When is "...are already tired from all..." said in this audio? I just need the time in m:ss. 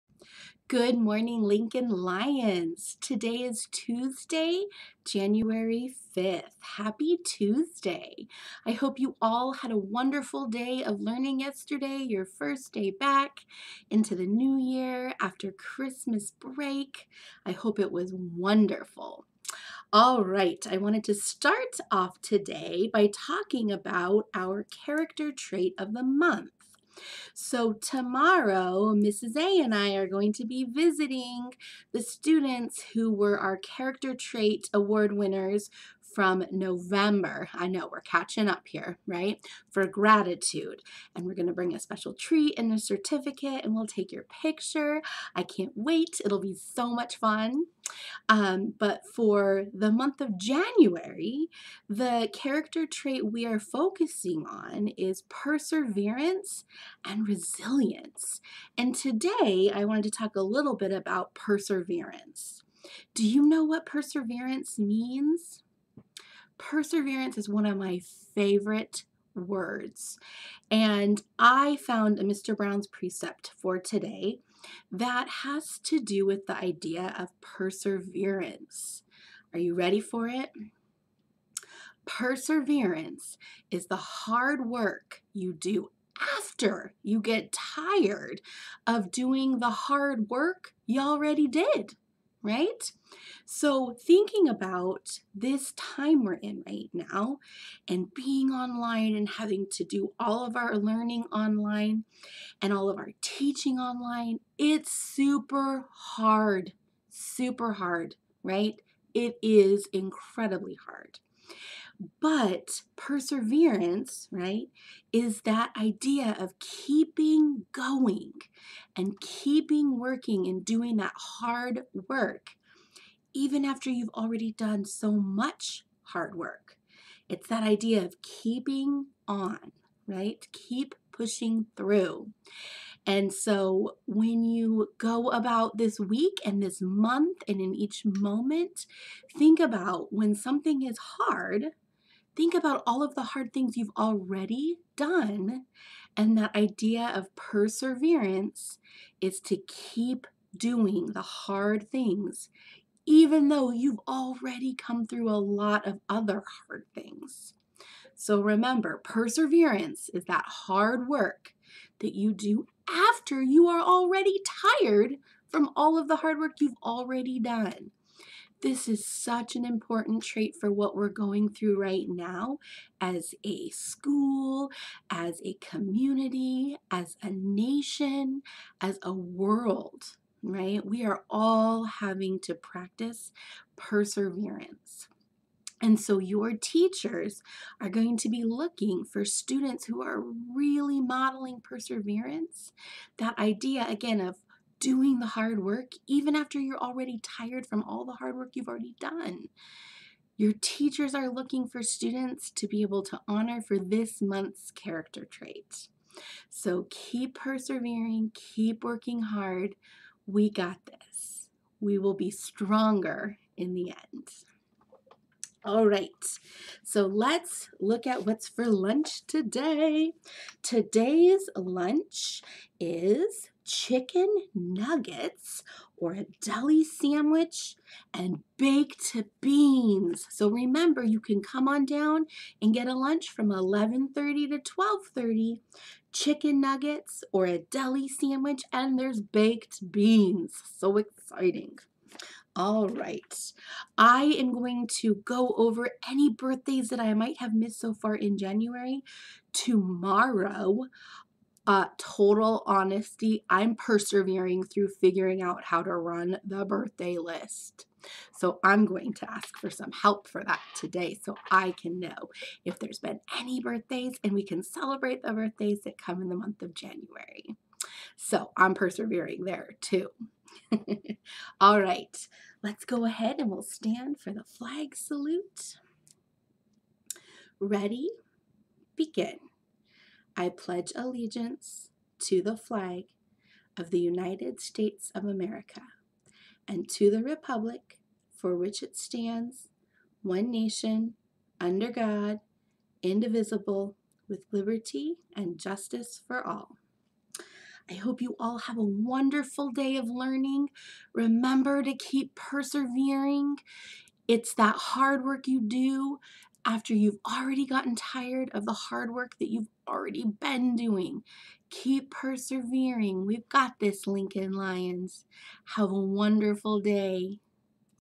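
2:43.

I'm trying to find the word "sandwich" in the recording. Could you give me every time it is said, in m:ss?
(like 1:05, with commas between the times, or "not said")
3:46, 3:58.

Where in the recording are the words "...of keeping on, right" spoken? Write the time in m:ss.
2:08.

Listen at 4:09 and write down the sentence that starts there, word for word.
Tomorrow, uh, total honesty, I'm persevering through figuring out how to run the birthday list.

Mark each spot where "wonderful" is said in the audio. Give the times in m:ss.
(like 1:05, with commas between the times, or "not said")
0:09, 0:18, 4:58, 5:15.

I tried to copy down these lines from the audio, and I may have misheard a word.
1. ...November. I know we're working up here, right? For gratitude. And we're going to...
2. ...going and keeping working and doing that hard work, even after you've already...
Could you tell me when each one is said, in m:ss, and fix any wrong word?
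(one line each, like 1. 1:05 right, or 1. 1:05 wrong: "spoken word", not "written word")
1. 0:36 wrong: "catching", not "working"
2. 1:57 right.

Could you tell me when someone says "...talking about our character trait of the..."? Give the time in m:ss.
0:23.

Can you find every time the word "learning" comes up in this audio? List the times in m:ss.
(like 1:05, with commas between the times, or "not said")
0:11, 1:40, 5:00.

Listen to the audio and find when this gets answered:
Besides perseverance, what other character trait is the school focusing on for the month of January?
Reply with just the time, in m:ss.
0:57.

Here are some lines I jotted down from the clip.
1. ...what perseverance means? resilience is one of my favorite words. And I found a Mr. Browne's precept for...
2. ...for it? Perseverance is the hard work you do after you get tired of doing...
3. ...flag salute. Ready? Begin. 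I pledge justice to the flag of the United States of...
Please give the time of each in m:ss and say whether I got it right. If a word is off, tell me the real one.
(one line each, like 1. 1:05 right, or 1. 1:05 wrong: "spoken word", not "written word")
1. 1:03 wrong: "perseverance", not "resilience"
2. 1:19 right
3. 4:34 wrong: "allegiance", not "justice".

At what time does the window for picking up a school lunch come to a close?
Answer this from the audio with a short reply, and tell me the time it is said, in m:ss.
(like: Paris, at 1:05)
12:30, at 3:54.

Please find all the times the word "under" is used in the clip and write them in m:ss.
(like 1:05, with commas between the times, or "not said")
4:51.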